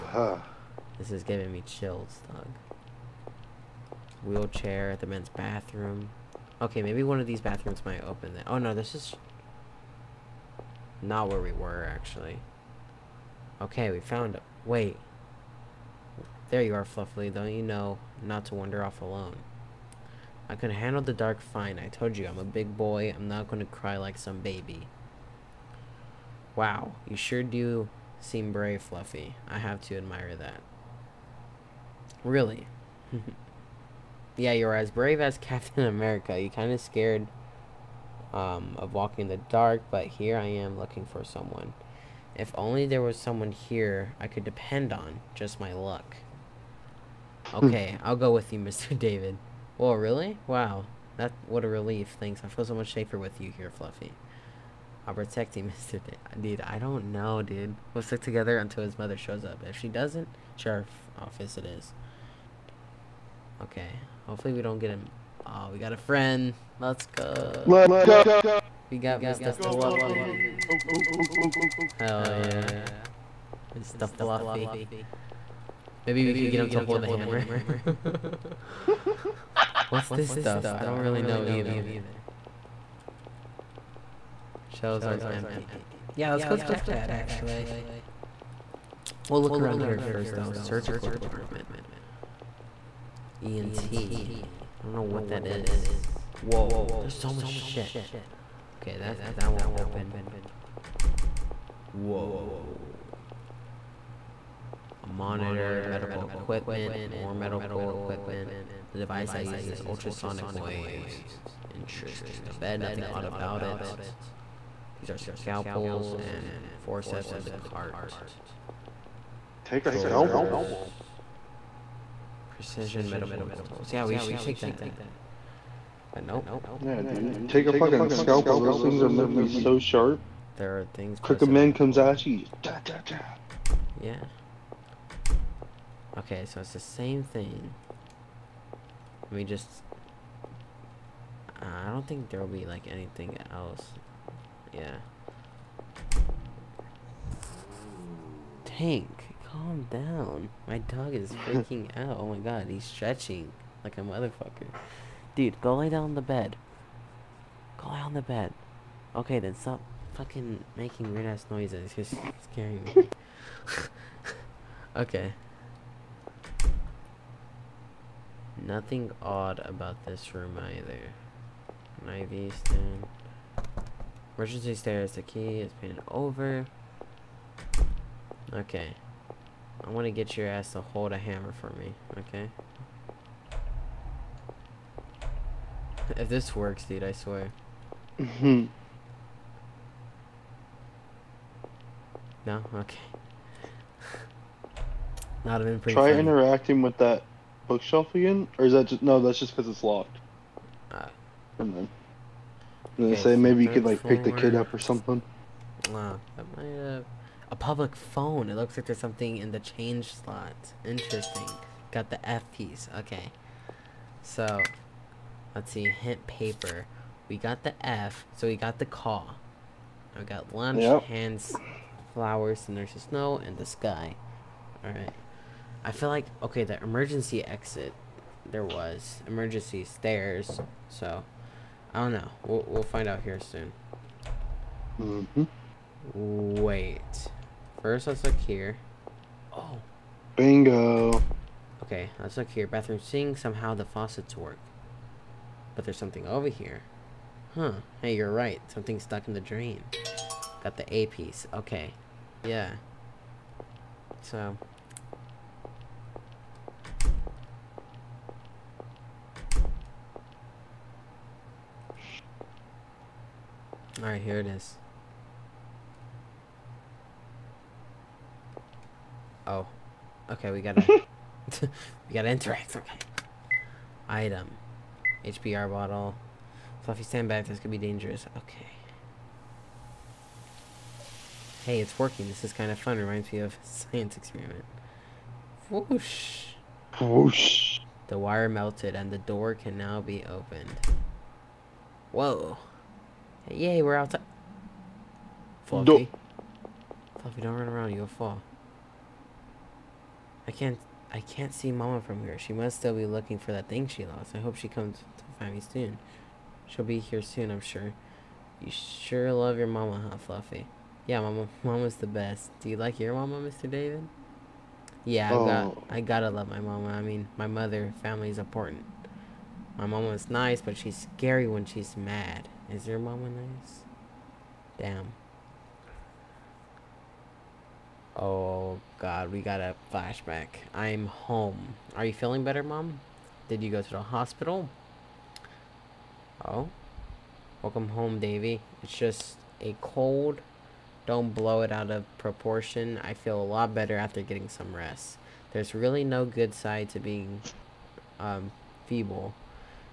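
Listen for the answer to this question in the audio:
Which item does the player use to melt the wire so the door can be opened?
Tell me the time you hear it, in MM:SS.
04:35.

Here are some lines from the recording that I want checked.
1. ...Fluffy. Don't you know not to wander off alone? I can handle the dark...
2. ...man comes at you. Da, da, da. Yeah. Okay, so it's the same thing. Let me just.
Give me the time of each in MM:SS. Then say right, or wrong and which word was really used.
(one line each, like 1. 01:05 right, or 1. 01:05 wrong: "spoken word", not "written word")
1. 00:16 right
2. 02:11 right.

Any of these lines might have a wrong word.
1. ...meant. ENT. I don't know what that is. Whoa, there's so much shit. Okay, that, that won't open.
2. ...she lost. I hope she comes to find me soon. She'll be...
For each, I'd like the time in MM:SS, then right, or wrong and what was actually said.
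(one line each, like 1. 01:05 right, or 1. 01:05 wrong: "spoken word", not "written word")
1. 01:31 wrong: "department", not "meant"
2. 05:03 right.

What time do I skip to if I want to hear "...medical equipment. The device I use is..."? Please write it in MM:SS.
01:47.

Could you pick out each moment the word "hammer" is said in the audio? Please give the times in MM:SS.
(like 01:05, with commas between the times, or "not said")
01:17, 03:01.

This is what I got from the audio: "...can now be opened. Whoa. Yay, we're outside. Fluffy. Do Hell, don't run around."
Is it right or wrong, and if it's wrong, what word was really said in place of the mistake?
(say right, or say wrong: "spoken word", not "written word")
wrong: "Fluffy", not "Hell".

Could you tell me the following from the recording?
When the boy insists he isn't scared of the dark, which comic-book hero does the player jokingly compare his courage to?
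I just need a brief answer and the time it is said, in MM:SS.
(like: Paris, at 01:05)
Captain America, at 00:35.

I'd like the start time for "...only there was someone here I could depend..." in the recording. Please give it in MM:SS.
00:42.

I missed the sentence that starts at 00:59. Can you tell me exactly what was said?
If she doesn't, sheriff office it is.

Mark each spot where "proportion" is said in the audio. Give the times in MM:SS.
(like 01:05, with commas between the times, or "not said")
05:42.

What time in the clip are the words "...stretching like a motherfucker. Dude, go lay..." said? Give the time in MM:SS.
02:32.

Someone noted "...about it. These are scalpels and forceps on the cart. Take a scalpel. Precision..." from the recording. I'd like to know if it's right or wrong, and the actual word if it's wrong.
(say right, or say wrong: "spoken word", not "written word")
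right.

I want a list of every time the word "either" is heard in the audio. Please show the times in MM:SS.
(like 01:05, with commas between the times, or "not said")
01:21, 02:50.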